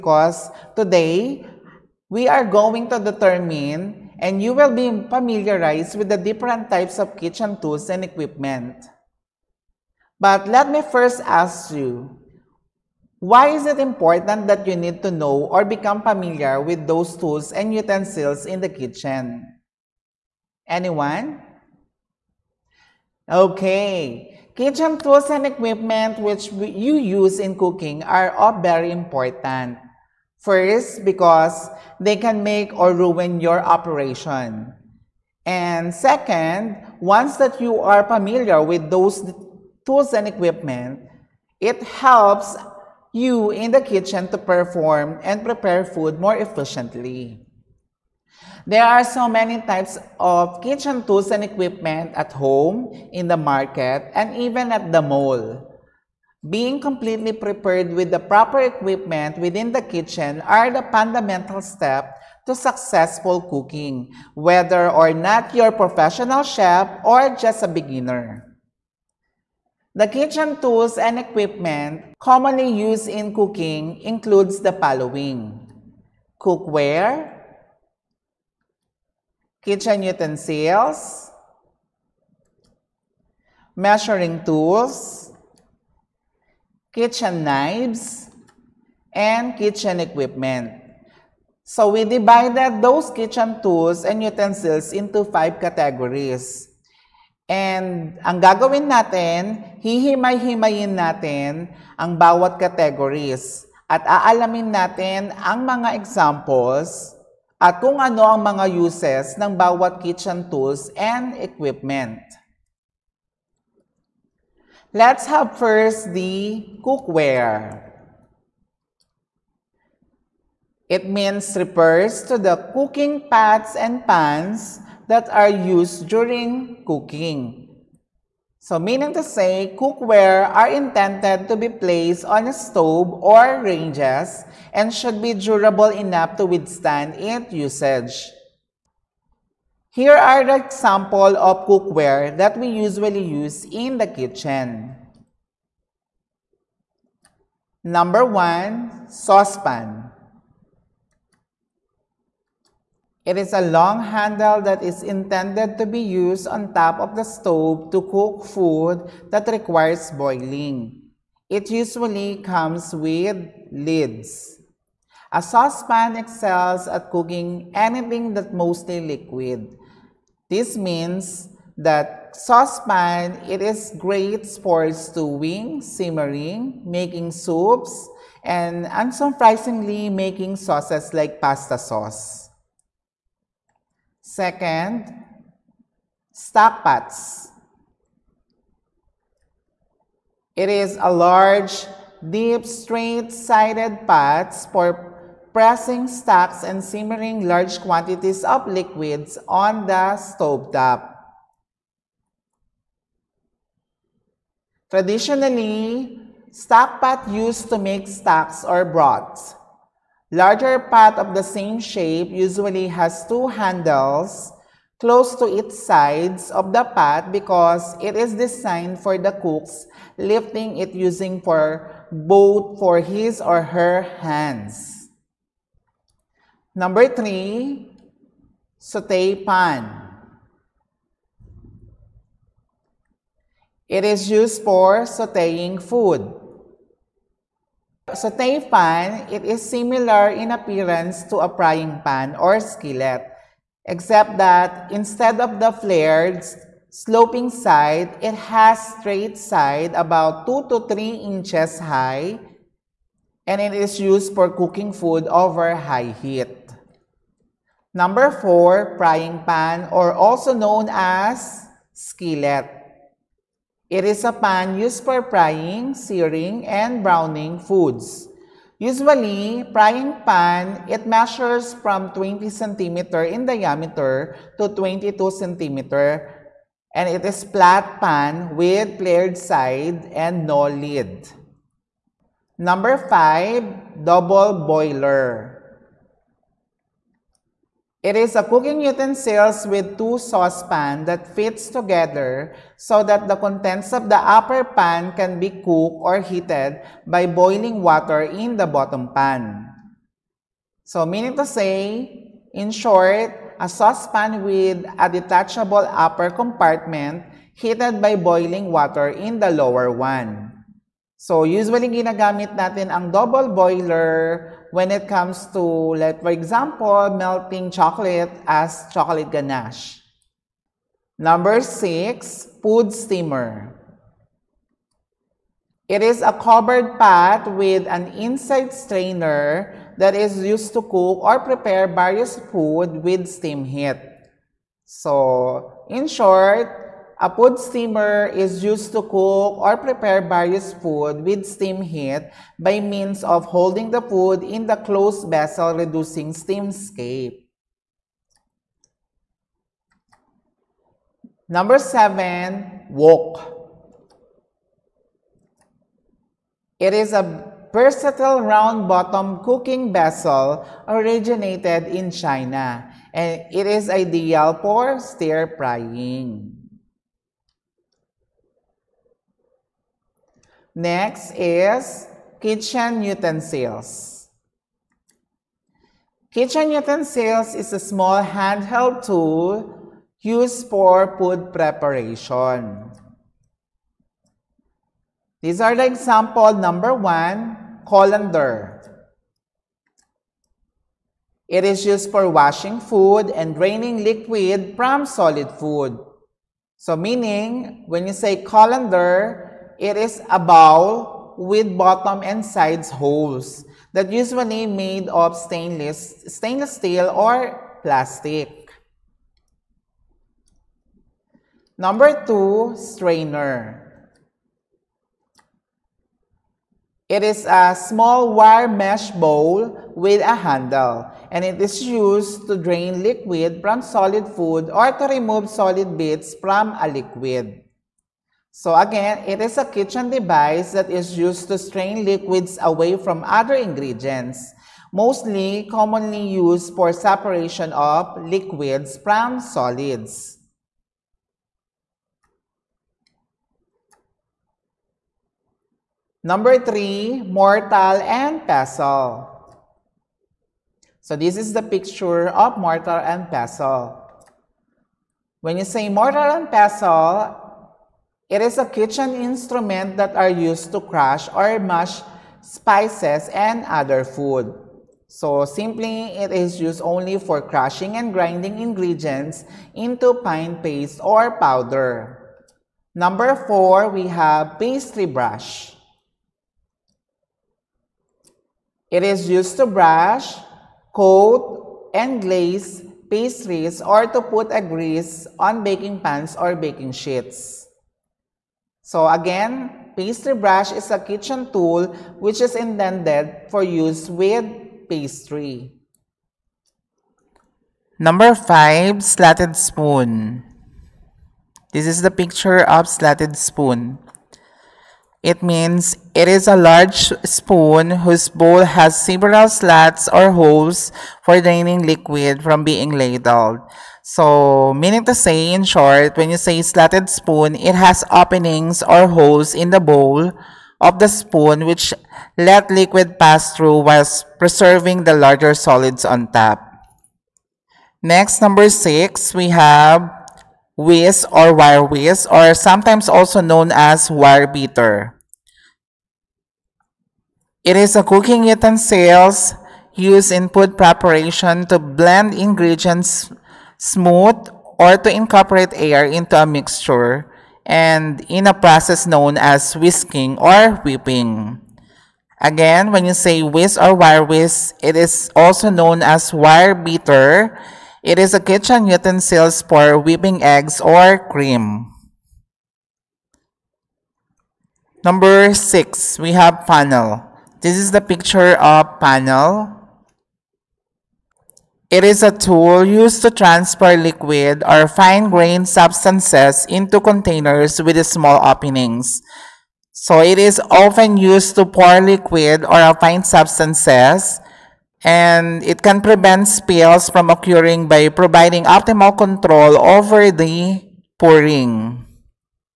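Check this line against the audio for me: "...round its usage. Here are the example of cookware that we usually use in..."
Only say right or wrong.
wrong.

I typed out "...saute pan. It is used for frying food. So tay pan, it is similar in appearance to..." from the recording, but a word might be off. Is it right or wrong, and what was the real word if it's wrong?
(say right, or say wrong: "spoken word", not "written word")
wrong: "sauteing", not "frying".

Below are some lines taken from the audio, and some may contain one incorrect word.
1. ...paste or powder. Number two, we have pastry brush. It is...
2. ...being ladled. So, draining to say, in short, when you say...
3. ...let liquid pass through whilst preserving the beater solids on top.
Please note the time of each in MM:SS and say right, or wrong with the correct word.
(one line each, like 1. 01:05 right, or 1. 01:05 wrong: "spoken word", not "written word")
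1. 07:50 wrong: "four", not "two"
2. 08:32 wrong: "meaning", not "draining"
3. 08:42 wrong: "larger", not "beater".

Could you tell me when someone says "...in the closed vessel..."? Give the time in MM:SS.
05:44.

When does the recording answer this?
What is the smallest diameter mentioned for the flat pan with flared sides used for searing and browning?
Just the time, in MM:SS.
04:32.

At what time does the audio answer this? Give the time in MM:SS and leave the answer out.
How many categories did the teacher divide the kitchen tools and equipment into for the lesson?
01:35.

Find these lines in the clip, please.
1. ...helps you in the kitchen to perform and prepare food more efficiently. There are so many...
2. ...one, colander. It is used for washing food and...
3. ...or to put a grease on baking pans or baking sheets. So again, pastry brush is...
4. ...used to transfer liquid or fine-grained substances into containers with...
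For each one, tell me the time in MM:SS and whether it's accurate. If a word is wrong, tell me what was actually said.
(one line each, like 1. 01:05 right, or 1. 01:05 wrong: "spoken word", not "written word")
1. 00:41 right
2. 06:26 right
3. 08:03 right
4. 09:32 right.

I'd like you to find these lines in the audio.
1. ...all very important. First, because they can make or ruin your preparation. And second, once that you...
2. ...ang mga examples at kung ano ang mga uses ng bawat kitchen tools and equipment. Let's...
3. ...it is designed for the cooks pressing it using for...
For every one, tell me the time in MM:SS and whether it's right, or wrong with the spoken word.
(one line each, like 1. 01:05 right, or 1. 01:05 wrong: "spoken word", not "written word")
1. 00:28 wrong: "operation", not "preparation"
2. 01:45 right
3. 03:37 wrong: "lifting", not "pressing".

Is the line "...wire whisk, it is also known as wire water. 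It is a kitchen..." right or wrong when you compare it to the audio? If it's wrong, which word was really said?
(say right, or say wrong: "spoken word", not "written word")
wrong: "beater", not "water".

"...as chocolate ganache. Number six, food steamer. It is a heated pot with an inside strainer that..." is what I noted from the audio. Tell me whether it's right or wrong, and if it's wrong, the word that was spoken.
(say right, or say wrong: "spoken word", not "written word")
wrong: "covered", not "heated".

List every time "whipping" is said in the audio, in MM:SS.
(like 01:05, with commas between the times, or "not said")
09:10, 09:19.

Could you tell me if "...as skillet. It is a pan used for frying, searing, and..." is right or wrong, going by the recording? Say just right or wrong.
right.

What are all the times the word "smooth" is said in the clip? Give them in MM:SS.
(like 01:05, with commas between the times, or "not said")
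09:03.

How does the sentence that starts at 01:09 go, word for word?
The kitchen tools and equipment commonly used in cooking includes the following.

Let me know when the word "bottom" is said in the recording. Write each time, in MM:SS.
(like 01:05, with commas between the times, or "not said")
04:58, 05:58, 06:41.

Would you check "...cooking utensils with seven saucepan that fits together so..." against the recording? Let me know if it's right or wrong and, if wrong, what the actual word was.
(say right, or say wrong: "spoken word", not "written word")
wrong: "two", not "seven".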